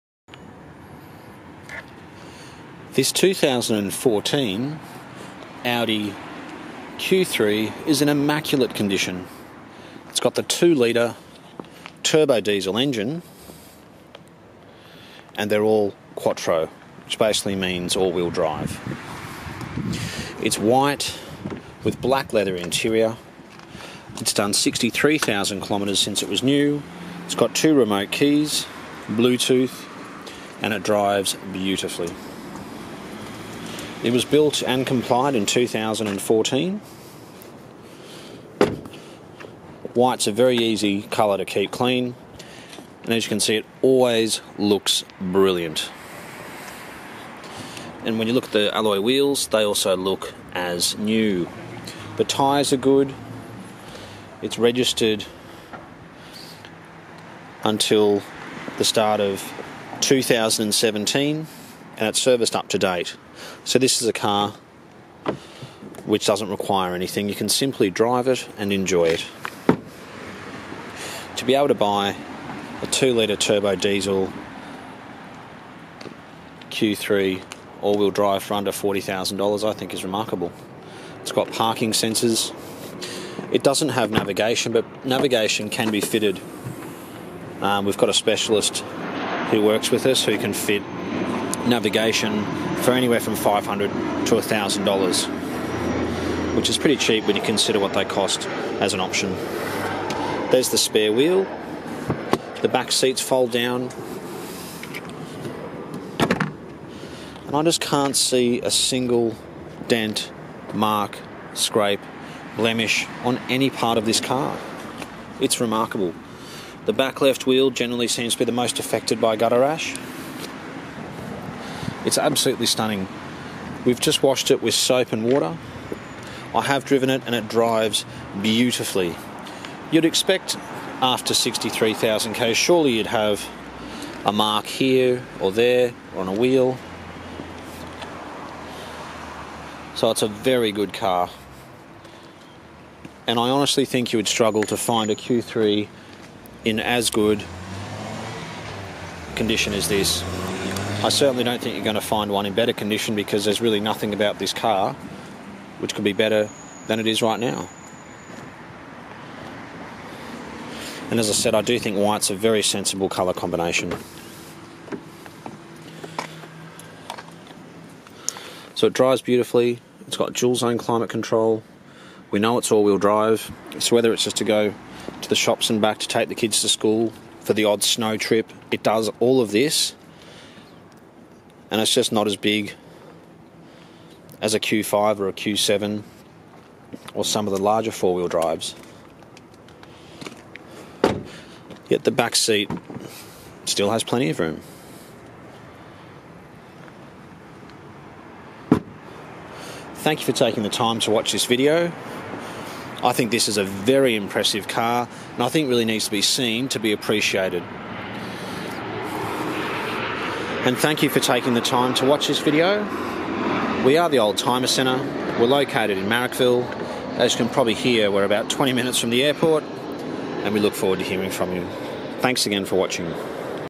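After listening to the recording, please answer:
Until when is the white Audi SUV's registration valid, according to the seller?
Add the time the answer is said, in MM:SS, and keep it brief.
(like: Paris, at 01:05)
start of 2017, at 00:58.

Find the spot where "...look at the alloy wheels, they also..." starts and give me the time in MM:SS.
00:48.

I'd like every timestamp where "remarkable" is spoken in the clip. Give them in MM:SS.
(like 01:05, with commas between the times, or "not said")
01:20, 01:55.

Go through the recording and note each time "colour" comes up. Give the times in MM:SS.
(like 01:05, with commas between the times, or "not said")
00:41, 02:43.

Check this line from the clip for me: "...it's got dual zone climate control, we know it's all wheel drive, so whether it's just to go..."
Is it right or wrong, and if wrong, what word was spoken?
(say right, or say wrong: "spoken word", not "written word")
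right.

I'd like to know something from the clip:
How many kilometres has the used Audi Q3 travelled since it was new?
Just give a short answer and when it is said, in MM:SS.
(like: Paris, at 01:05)
63,000 kilometres, at 00:24.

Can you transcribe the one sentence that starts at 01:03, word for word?
So this is a car which doesn't require anything.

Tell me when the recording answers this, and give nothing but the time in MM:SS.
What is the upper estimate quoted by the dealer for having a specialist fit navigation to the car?
01:34.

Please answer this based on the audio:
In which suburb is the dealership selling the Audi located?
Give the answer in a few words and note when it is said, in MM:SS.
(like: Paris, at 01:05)
Marrickville, at 03:36.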